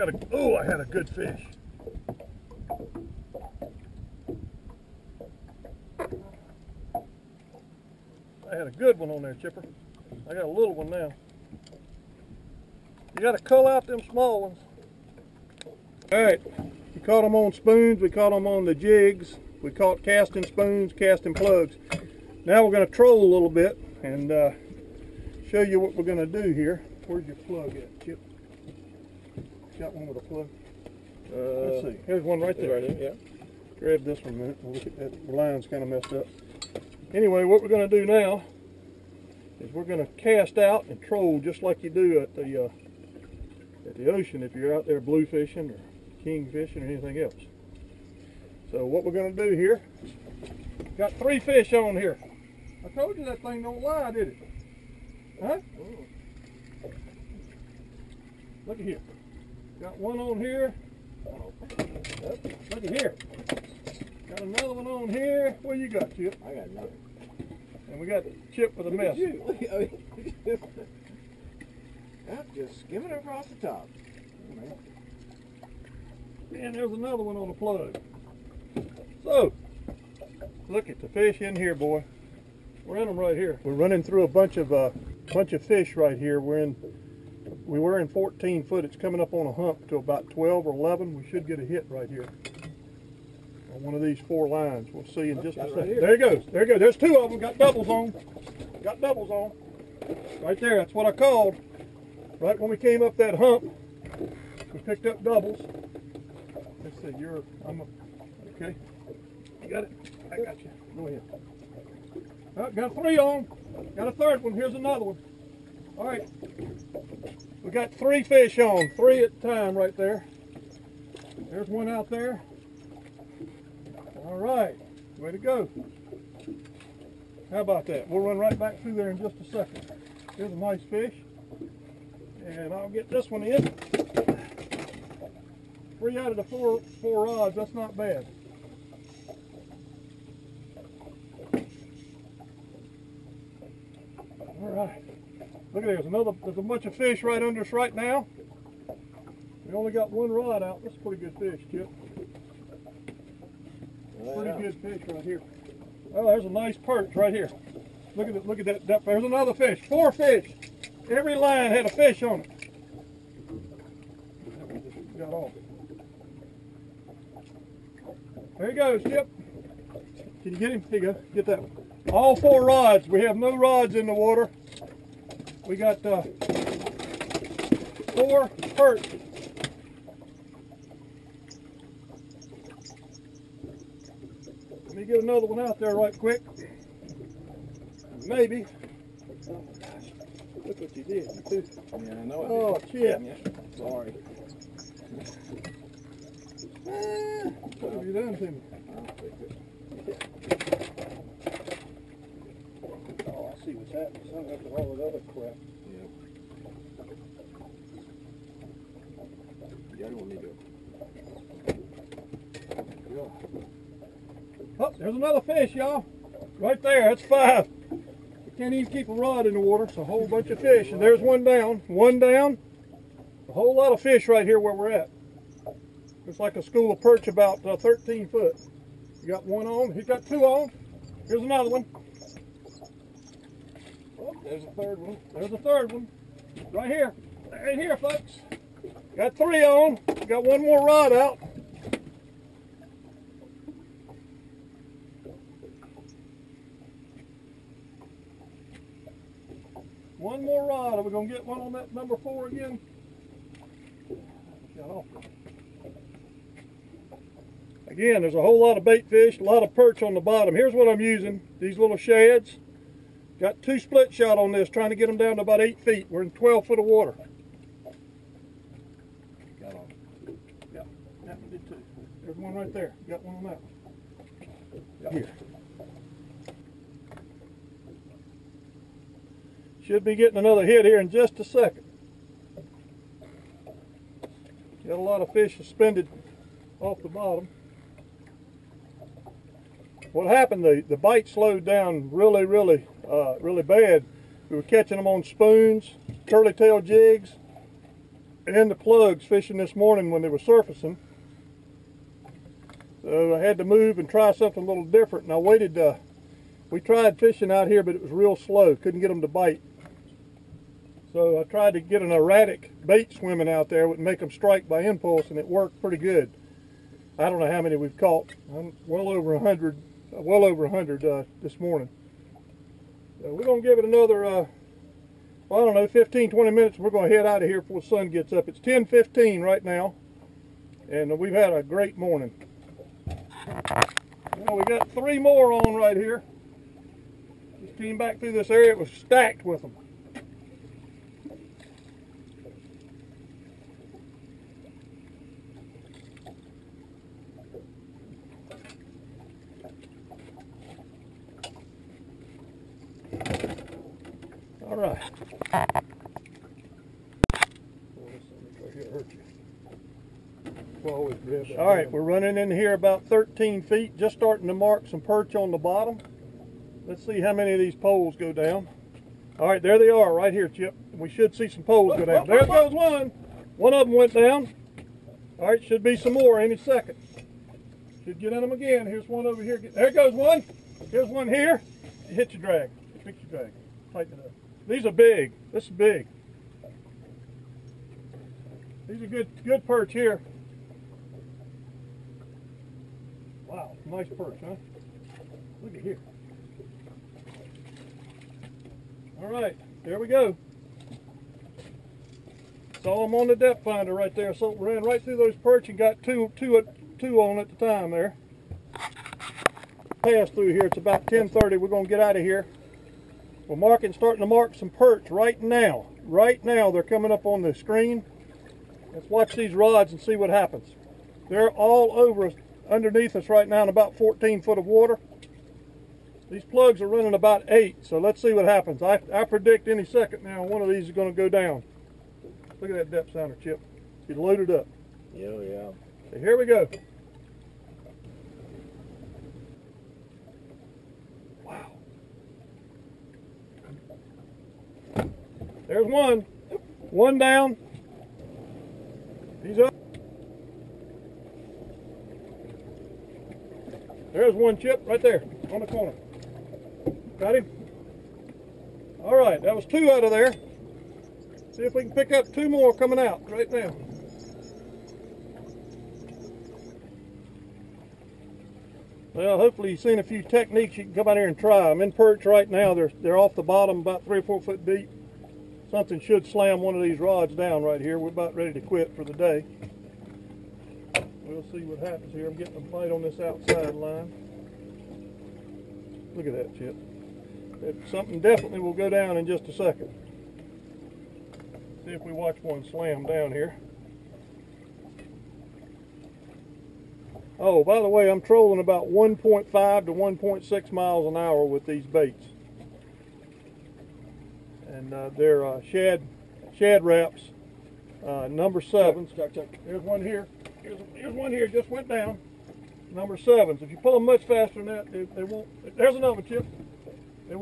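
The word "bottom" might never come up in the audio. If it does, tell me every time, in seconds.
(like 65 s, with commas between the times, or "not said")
260 s, 287 s, 365 s, 473 s.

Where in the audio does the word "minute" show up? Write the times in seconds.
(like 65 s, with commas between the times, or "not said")
34 s, 326 s.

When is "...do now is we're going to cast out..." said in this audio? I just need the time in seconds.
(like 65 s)
37 s.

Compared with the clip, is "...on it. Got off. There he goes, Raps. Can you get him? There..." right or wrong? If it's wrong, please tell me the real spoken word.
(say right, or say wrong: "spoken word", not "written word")
wrong: "Yep", not "Raps".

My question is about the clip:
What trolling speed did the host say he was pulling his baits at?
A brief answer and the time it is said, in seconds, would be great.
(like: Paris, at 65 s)
1.5 to 1.6 mph, at 498 s.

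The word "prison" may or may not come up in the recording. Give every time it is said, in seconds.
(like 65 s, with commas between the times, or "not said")
not said.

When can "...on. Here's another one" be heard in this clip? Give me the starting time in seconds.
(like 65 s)
230 s.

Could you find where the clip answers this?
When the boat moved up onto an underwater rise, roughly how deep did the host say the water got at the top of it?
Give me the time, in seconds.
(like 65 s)
90 s.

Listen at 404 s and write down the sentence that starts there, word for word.
So ran right through those perch and got two, two, two on at the time there.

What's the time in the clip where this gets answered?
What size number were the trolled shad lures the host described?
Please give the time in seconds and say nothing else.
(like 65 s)
508 s.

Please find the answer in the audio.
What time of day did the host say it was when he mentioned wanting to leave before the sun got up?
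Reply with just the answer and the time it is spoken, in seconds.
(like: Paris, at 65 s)
10:15, at 328 s.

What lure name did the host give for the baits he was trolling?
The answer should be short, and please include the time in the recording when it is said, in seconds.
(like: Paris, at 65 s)
Shad Raps, at 506 s.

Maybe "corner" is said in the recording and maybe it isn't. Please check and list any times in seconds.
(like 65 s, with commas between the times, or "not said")
455 s.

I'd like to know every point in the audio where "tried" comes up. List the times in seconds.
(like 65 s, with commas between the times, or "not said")
306 s, 311 s.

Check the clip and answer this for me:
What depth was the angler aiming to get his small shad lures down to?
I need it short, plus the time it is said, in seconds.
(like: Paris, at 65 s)
8 feet, at 265 s.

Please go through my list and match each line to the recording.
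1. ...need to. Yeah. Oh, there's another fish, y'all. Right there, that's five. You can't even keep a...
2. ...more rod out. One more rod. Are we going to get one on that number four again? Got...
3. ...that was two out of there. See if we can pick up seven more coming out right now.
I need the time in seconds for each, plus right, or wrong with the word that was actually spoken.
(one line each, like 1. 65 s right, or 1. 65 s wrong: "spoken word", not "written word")
1. 210 s right
2. 240 s right
3. 459 s wrong: "two", not "seven".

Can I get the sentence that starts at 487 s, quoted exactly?
something definitely will go down in just a second.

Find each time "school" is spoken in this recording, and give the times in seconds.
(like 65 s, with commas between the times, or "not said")
226 s.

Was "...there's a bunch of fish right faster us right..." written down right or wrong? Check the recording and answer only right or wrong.
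wrong.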